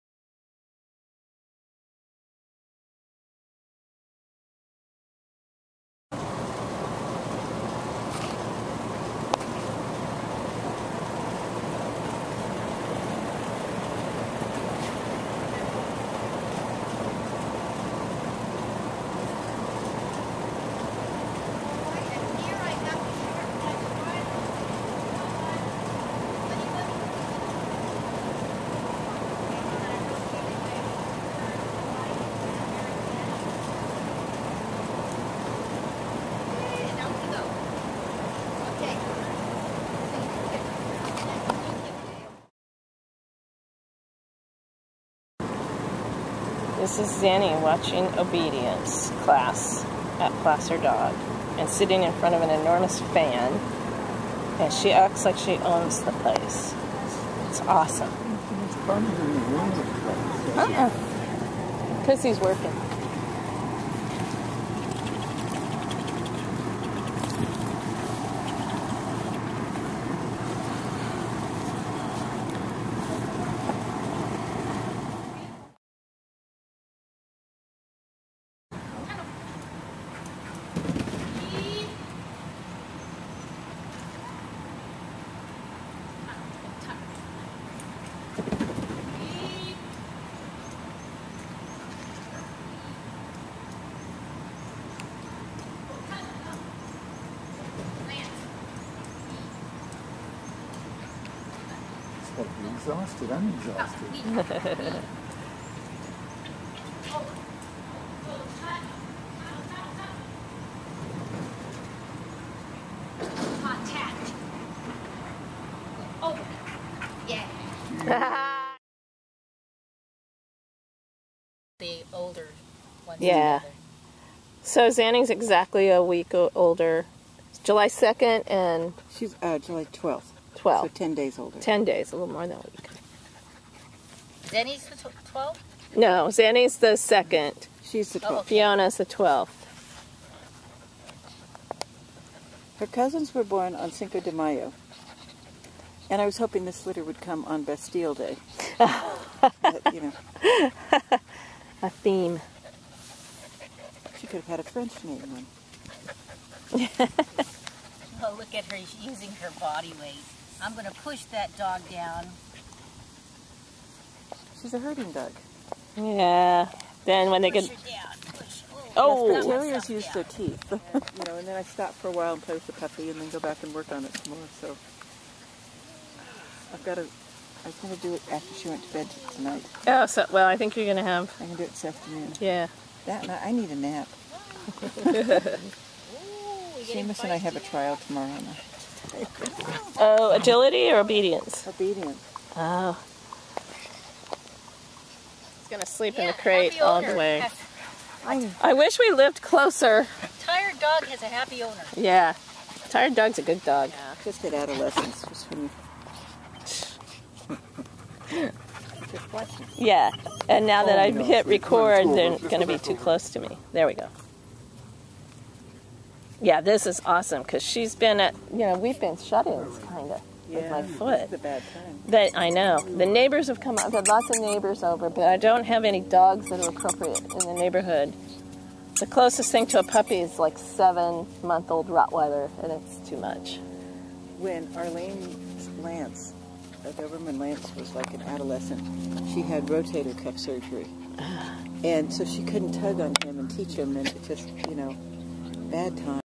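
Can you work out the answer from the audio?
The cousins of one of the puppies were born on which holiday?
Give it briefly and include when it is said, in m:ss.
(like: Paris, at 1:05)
Cinco de Mayo, at 2:23.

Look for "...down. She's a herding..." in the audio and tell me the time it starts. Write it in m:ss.
2:41.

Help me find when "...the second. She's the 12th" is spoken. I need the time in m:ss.
2:16.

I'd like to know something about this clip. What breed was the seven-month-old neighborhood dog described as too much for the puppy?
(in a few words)
Rottweiler.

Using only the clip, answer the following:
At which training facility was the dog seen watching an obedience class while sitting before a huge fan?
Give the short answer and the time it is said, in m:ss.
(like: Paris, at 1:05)
Placer Dog, at 0:50.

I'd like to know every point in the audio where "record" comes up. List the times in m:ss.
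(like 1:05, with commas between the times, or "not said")
3:31.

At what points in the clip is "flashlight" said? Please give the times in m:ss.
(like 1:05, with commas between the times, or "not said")
not said.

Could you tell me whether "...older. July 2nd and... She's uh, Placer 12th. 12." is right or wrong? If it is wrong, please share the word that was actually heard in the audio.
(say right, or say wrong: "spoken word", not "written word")
wrong: "July", not "Placer".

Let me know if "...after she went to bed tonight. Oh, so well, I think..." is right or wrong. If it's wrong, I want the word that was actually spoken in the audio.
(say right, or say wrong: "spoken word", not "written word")
right.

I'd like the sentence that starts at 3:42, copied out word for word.
The neighbors have come I've had lots of neighbors over, but I don't have any dogs that are appropriate in the neighborhood.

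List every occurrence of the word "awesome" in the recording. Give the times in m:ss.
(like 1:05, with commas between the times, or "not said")
0:57, 3:37.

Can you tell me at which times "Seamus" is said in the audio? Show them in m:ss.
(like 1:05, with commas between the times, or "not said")
3:06.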